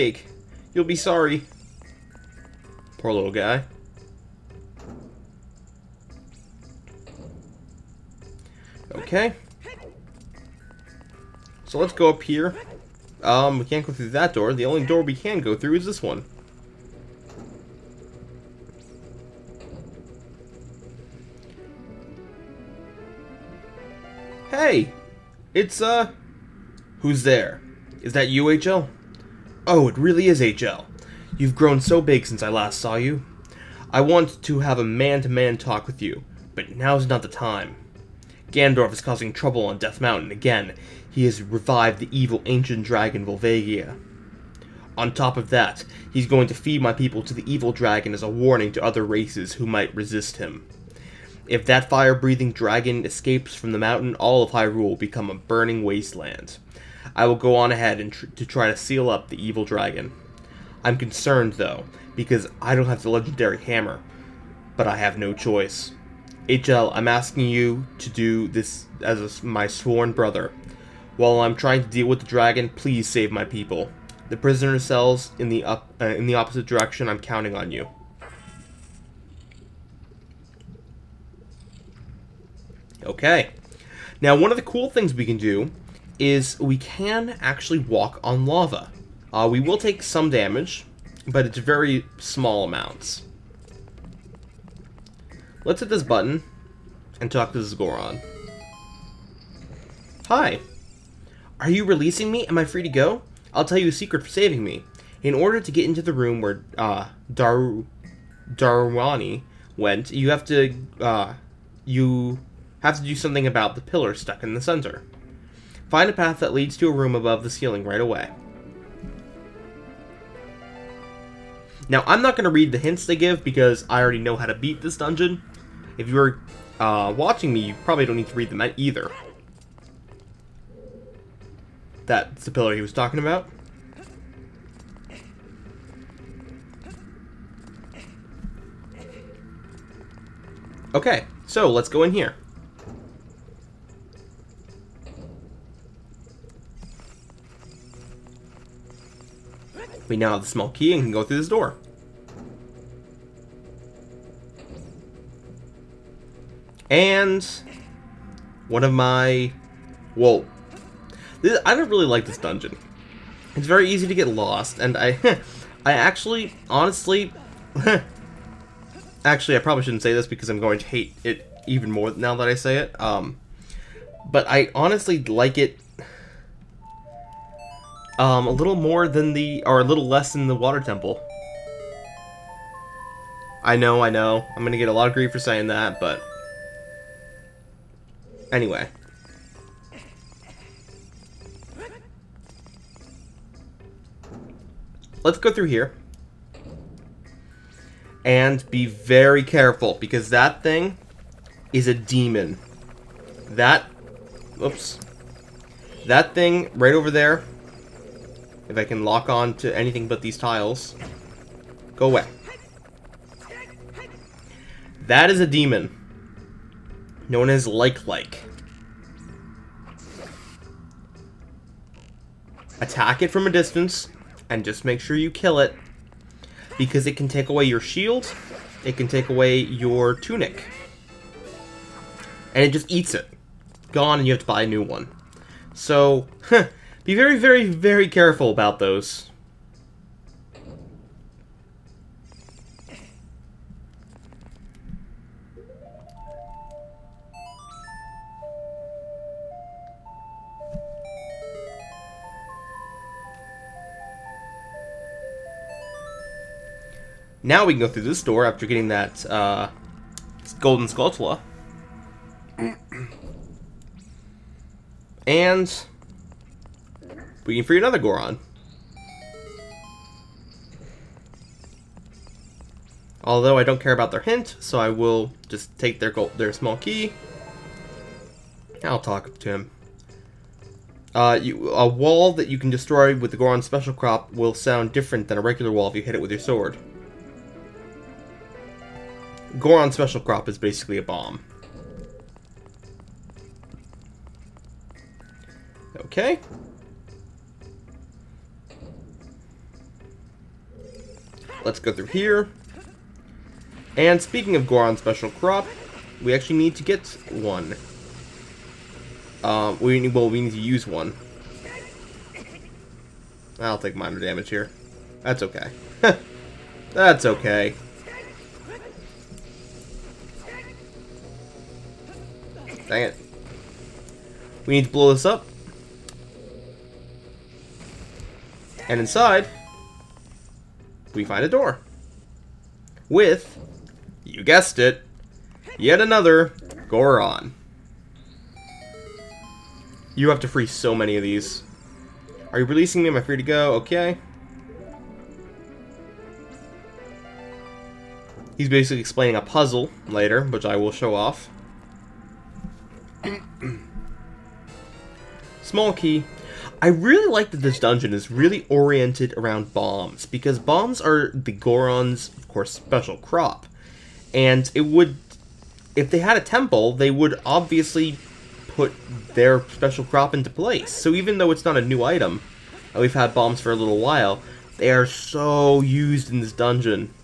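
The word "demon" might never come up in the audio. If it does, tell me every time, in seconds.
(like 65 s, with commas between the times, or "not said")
201 s, 215 s.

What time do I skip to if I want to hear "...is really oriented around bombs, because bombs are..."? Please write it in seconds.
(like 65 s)
358 s.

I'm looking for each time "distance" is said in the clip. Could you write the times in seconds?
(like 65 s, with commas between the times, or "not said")
223 s.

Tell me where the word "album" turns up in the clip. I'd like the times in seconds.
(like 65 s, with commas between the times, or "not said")
not said.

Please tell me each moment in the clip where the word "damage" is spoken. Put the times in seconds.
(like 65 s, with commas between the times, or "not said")
90 s, 314 s.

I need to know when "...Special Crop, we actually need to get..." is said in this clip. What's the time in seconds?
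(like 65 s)
304 s.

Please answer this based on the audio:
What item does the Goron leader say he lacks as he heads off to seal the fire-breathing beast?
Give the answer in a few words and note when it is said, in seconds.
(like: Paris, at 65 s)
the legendary hammer, at 63 s.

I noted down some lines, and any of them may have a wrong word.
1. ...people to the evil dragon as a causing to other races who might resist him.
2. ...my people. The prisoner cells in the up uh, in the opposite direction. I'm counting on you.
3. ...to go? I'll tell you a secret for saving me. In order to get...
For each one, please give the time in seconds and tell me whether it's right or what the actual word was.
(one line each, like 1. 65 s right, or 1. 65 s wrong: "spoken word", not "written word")
1. 46 s wrong: "warning", not "causing"
2. 73 s right
3. 102 s right.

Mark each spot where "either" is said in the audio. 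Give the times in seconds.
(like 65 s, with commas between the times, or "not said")
128 s.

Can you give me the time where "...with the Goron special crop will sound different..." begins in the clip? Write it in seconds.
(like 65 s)
283 s.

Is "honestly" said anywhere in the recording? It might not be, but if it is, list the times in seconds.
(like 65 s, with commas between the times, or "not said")
166 s, 174 s.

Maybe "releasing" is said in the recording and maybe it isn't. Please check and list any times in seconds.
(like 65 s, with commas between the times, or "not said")
101 s, 342 s.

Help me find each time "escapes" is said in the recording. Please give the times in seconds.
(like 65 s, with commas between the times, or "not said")
53 s.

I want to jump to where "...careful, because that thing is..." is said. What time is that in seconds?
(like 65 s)
199 s.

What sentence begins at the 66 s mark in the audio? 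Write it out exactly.
HL, I'm asking you to do this as a, my sworn brother.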